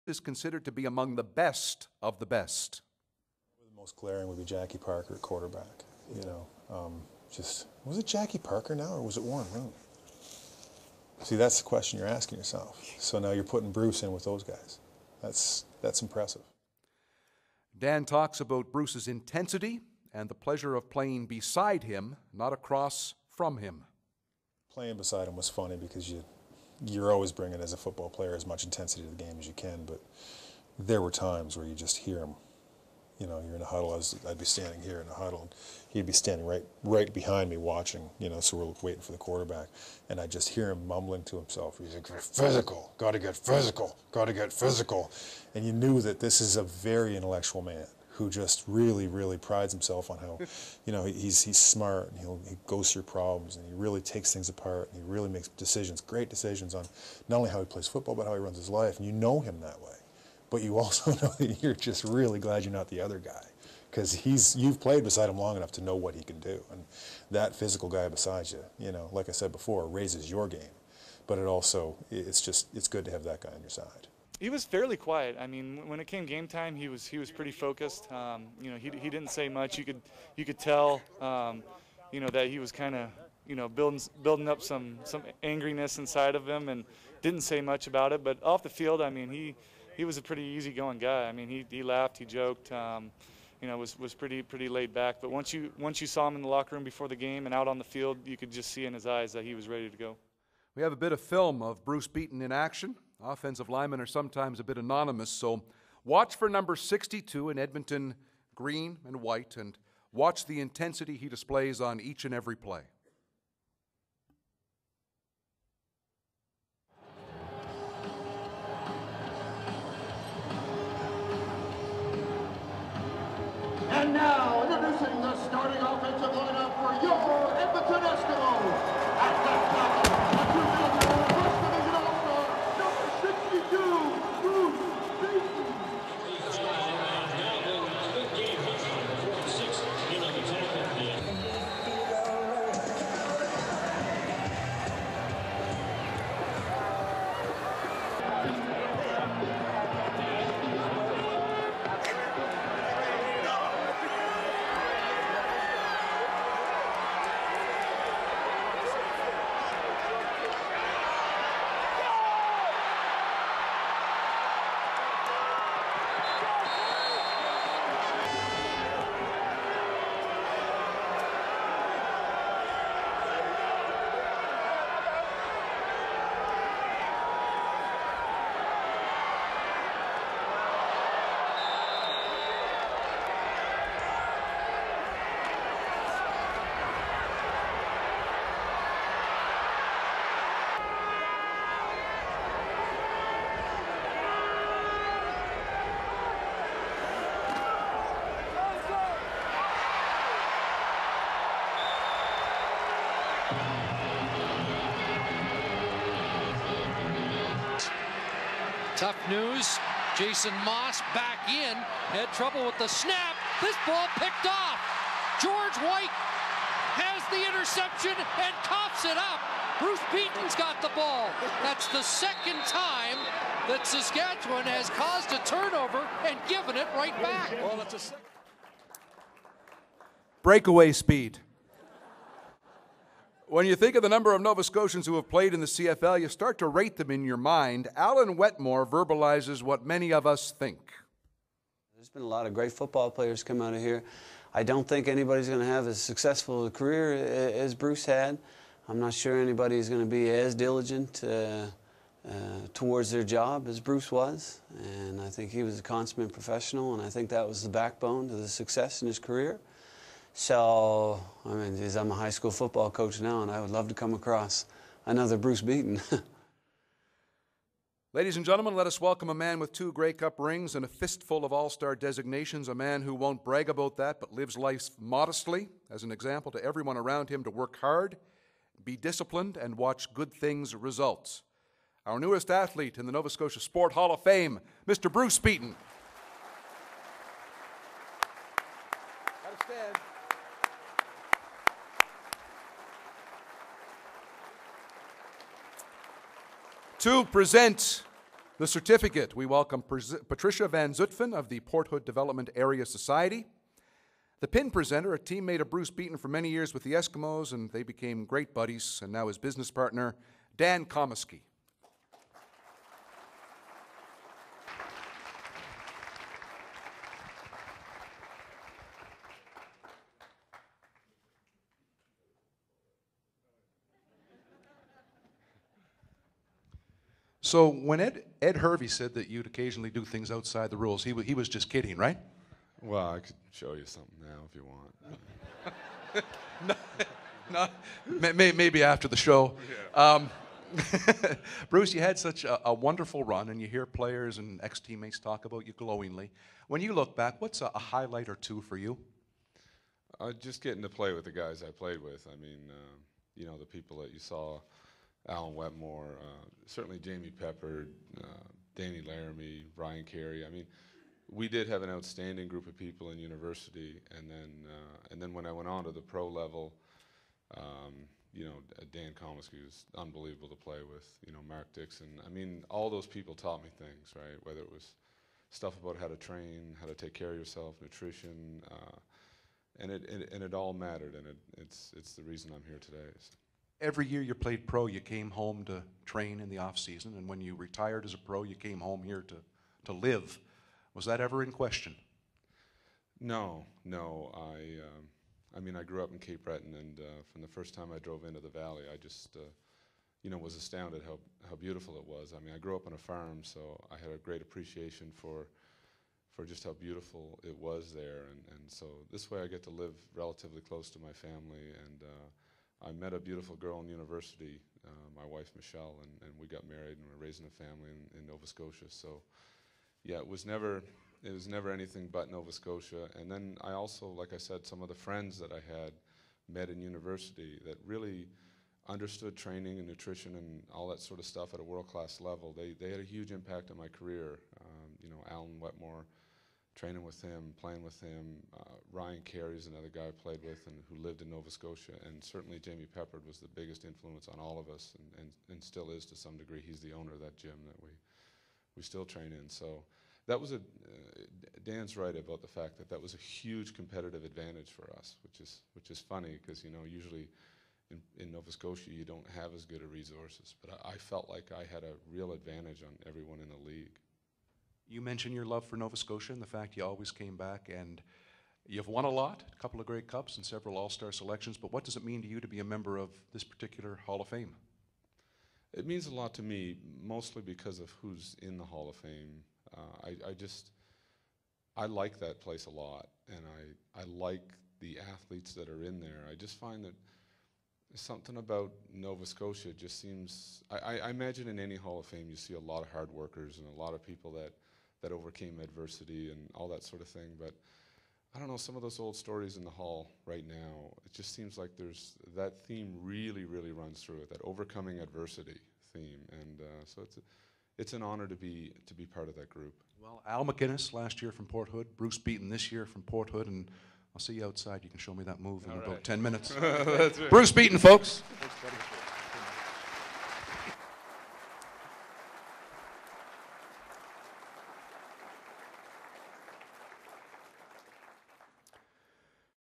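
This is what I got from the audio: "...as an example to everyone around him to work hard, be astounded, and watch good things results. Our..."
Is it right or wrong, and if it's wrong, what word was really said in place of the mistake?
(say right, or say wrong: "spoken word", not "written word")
wrong: "disciplined", not "astounded".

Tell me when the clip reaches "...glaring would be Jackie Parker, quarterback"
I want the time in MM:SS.
00:03.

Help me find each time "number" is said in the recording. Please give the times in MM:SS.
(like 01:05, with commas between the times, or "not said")
01:46, 03:54.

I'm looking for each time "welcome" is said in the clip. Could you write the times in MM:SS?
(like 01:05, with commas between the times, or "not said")
04:28, 04:59.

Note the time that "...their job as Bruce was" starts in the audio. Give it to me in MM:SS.
04:13.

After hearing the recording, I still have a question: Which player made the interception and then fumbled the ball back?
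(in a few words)
George White.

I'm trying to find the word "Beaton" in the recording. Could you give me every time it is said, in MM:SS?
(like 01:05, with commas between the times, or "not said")
01:42, 03:40, 04:25, 04:45, 05:05, 08:32, 08:37.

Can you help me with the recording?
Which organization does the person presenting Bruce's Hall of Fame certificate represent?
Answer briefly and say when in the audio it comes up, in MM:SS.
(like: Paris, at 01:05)
Port Hood Development Area Society, at 05:01.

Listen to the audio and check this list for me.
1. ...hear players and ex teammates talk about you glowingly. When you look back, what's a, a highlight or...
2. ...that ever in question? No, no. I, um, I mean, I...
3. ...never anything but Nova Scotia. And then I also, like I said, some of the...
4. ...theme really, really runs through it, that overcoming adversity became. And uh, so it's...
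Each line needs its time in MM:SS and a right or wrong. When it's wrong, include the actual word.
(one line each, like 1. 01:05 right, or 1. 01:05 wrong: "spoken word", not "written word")
1. 05:43 right
2. 06:31 right
3. 07:01 right
4. 08:22 wrong: "theme", not "became".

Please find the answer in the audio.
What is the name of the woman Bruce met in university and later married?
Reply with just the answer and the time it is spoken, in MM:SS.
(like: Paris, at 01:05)
Michelle, at 06:55.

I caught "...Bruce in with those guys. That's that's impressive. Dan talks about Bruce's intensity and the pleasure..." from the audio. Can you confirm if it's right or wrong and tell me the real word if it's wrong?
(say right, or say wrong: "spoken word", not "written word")
right.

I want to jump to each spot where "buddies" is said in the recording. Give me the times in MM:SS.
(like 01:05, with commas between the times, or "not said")
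05:08.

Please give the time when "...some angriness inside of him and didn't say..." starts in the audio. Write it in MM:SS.
01:25.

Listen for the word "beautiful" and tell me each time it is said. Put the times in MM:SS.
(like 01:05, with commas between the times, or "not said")
06:41, 06:46, 06:53.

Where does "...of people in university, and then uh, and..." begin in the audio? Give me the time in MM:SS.
06:02.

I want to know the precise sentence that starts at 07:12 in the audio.
They, they had a huge impact on my career.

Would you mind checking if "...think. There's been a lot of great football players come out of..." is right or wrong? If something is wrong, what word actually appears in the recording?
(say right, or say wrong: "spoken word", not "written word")
right.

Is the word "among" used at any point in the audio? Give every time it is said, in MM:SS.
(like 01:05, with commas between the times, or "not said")
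00:00.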